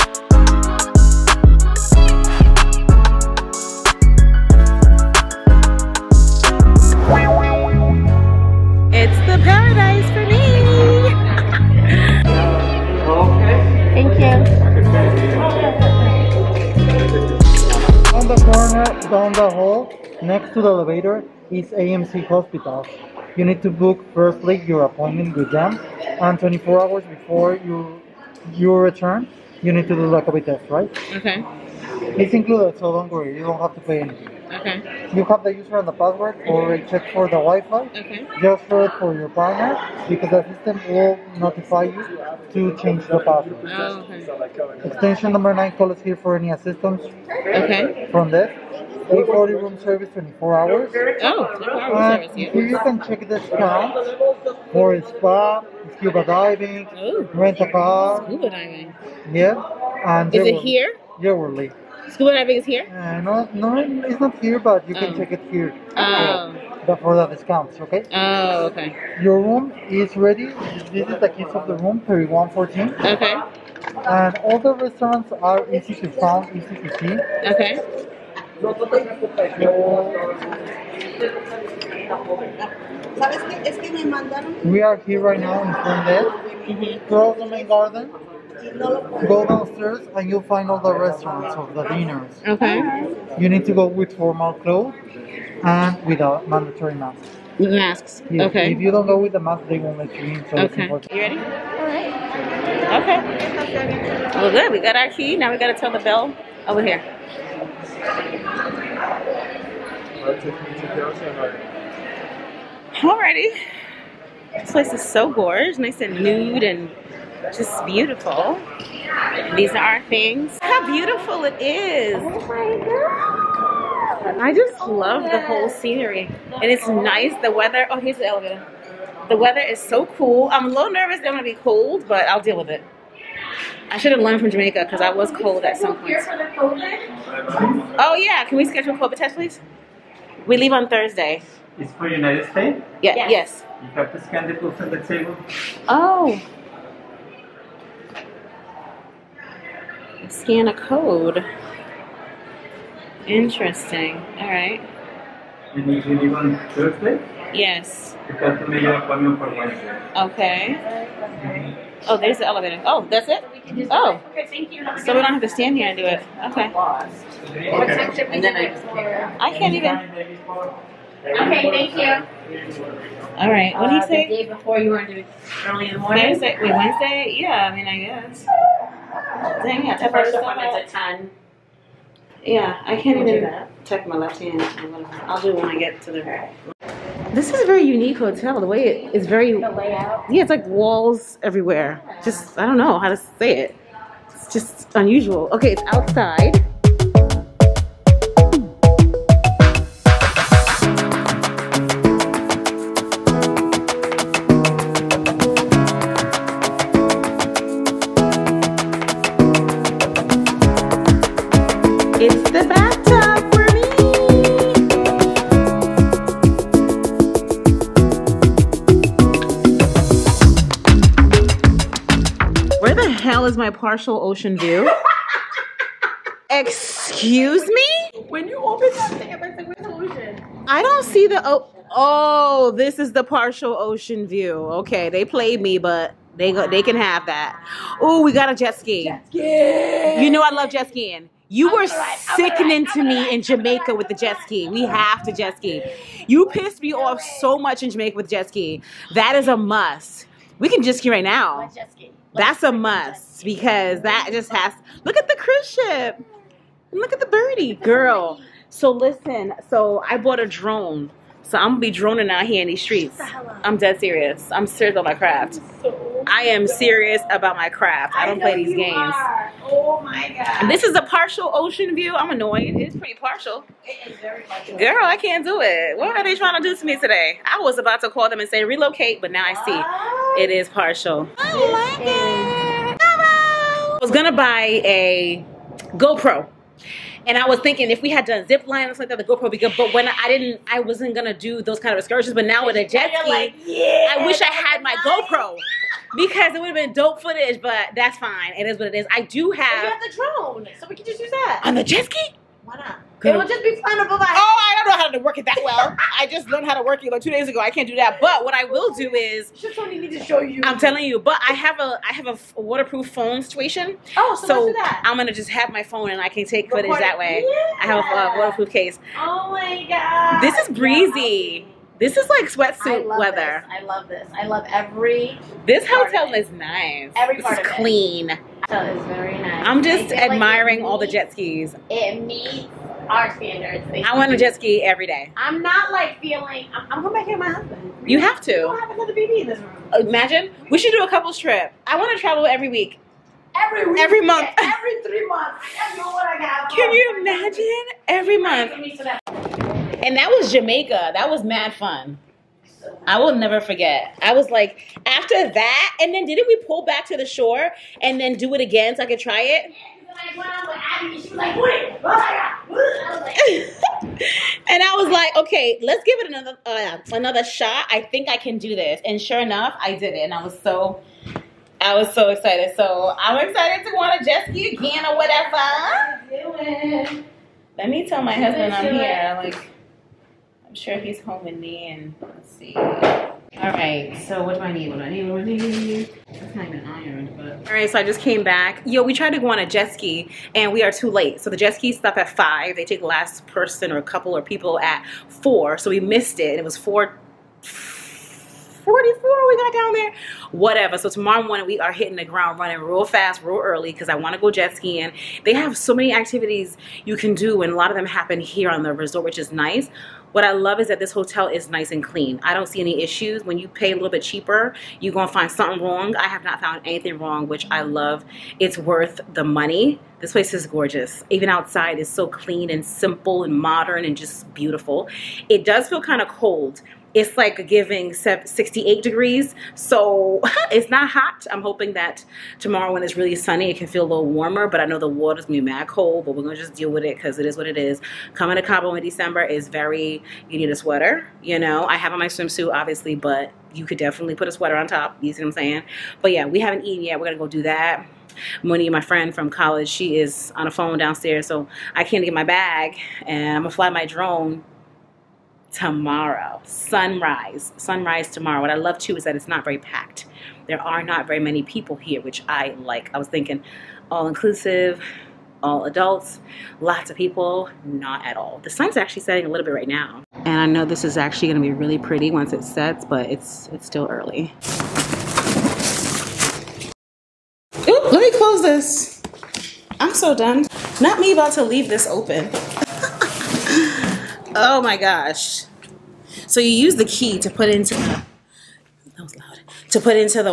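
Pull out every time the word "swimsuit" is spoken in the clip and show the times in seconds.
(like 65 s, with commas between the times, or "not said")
442 s.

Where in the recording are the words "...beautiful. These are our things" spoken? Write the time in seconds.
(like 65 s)
117 s.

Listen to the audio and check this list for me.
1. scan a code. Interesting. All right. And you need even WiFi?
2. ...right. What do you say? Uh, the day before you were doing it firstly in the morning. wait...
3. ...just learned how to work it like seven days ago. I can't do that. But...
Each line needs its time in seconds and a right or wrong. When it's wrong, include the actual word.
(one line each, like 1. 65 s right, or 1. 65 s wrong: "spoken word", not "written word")
1. 150 s wrong: "Thursday", not "WiFi"
2. 173 s wrong: "early", not "firstly"
3. 306 s wrong: "two", not "seven".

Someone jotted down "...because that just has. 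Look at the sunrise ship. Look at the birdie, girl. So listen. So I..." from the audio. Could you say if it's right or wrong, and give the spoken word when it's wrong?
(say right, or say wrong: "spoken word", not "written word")
wrong: "cruise", not "sunrise".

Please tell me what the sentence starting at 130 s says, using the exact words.
I'm a little nervous that gonna be cold, but I'll deal with it.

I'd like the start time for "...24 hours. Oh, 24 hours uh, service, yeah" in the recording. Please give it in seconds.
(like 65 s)
50 s.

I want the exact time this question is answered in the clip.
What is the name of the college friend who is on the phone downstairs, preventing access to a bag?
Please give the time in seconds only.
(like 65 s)
448 s.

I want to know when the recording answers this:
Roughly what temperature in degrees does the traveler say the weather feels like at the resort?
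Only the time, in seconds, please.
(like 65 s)
428 s.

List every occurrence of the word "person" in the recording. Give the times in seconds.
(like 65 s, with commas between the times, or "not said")
393 s.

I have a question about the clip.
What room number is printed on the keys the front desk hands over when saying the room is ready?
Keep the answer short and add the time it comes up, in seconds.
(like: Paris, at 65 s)
3114, at 72 s.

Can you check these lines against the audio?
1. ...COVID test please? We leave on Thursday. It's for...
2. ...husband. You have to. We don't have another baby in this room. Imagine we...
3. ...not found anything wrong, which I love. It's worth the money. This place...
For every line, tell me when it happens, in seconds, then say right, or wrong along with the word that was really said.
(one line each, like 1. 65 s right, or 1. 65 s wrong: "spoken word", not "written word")
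1. 138 s right
2. 337 s right
3. 416 s right.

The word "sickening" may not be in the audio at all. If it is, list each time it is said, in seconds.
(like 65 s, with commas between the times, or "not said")
242 s.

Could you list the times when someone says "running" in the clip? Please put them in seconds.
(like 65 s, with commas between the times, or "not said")
402 s.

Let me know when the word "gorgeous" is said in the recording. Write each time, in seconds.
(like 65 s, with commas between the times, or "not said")
115 s, 420 s.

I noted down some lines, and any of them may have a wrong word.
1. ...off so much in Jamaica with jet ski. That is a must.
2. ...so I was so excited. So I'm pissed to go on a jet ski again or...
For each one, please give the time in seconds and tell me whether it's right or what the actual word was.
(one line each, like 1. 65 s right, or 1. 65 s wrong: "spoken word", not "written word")
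1. 246 s right
2. 370 s wrong: "excited", not "pissed".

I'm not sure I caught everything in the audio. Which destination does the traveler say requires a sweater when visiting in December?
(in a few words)
Cabo.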